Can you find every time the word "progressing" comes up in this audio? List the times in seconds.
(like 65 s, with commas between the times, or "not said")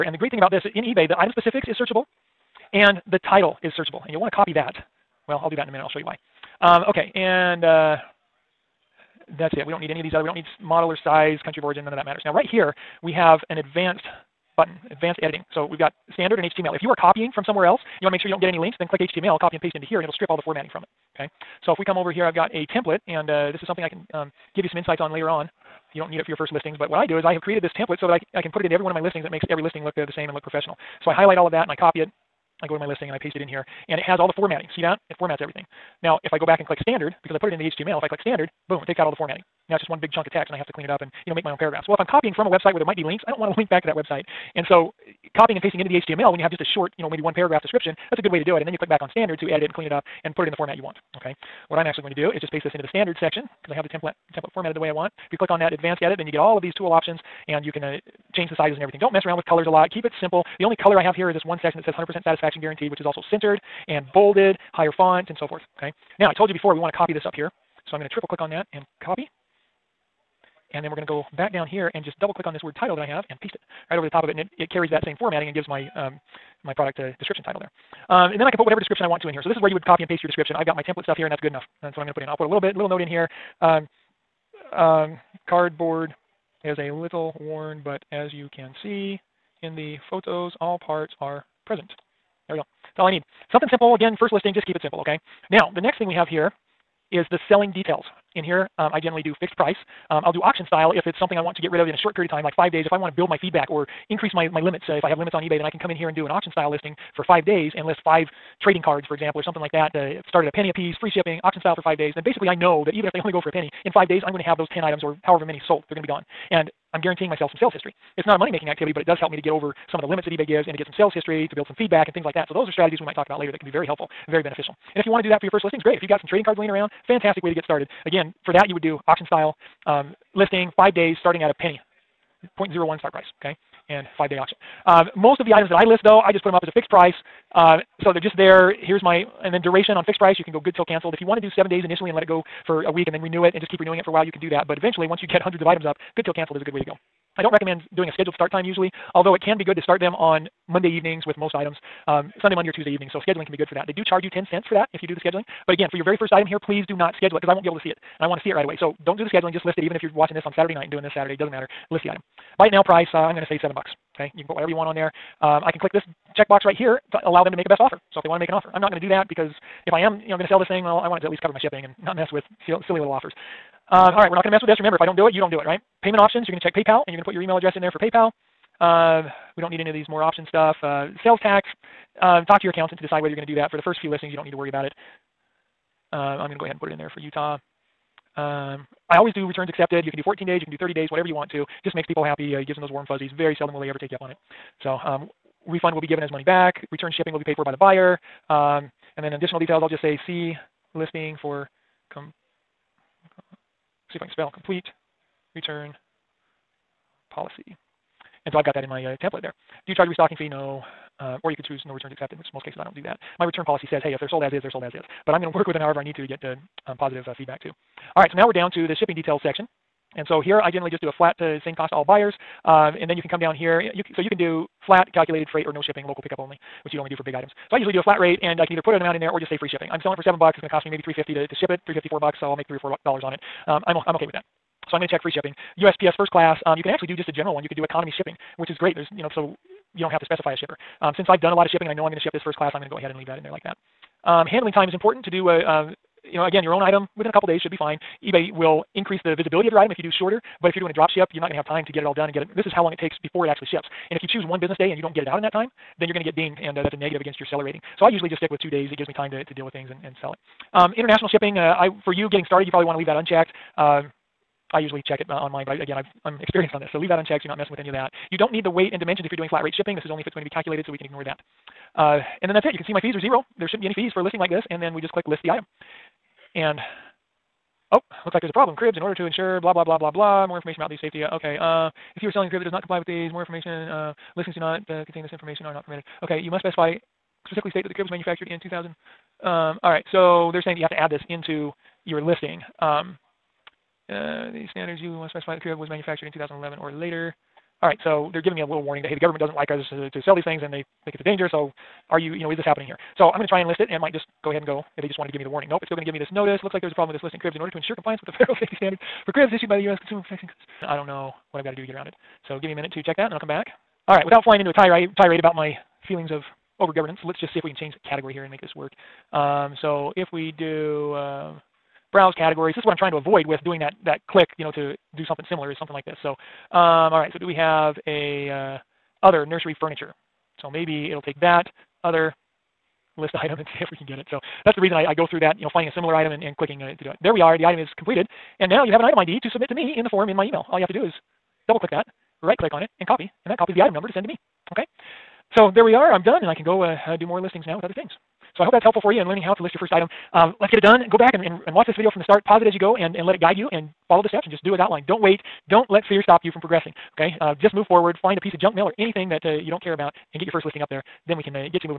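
356 s.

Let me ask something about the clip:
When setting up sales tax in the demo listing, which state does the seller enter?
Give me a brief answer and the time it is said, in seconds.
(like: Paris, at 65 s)
Utah, at 187 s.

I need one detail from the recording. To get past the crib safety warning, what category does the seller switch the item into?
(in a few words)
other nursery furniture.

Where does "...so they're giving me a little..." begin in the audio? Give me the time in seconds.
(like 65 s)
298 s.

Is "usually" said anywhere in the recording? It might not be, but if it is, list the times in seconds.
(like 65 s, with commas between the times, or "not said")
148 s, 227 s, 258 s, 264 s.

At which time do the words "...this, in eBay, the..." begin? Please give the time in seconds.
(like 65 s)
0 s.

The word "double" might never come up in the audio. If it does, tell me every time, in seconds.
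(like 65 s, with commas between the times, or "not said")
72 s, 341 s.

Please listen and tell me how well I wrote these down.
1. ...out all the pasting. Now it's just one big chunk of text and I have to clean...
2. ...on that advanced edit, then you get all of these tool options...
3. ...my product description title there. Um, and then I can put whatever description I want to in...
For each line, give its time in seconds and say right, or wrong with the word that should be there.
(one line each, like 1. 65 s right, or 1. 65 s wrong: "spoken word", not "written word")
1. 38 s wrong: "formatting", not "pasting"
2. 55 s right
3. 76 s right.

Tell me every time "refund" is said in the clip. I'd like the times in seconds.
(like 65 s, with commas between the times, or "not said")
195 s.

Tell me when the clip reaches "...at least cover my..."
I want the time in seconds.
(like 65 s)
171 s.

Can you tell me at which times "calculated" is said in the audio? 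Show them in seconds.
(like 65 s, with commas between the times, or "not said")
225 s, 270 s.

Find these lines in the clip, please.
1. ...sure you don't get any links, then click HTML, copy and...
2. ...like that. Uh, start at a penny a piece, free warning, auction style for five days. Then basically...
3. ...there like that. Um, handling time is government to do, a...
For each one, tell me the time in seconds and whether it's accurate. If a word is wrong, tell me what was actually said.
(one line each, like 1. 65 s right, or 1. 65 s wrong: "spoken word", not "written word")
1. 18 s right
2. 109 s wrong: "shipping", not "warning"
3. 243 s wrong: "important", not "government".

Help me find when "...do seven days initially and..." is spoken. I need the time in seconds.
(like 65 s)
141 s.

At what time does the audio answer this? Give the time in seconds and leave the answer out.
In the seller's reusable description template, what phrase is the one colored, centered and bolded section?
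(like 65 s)
61 s.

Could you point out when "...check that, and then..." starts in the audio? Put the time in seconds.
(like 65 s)
313 s.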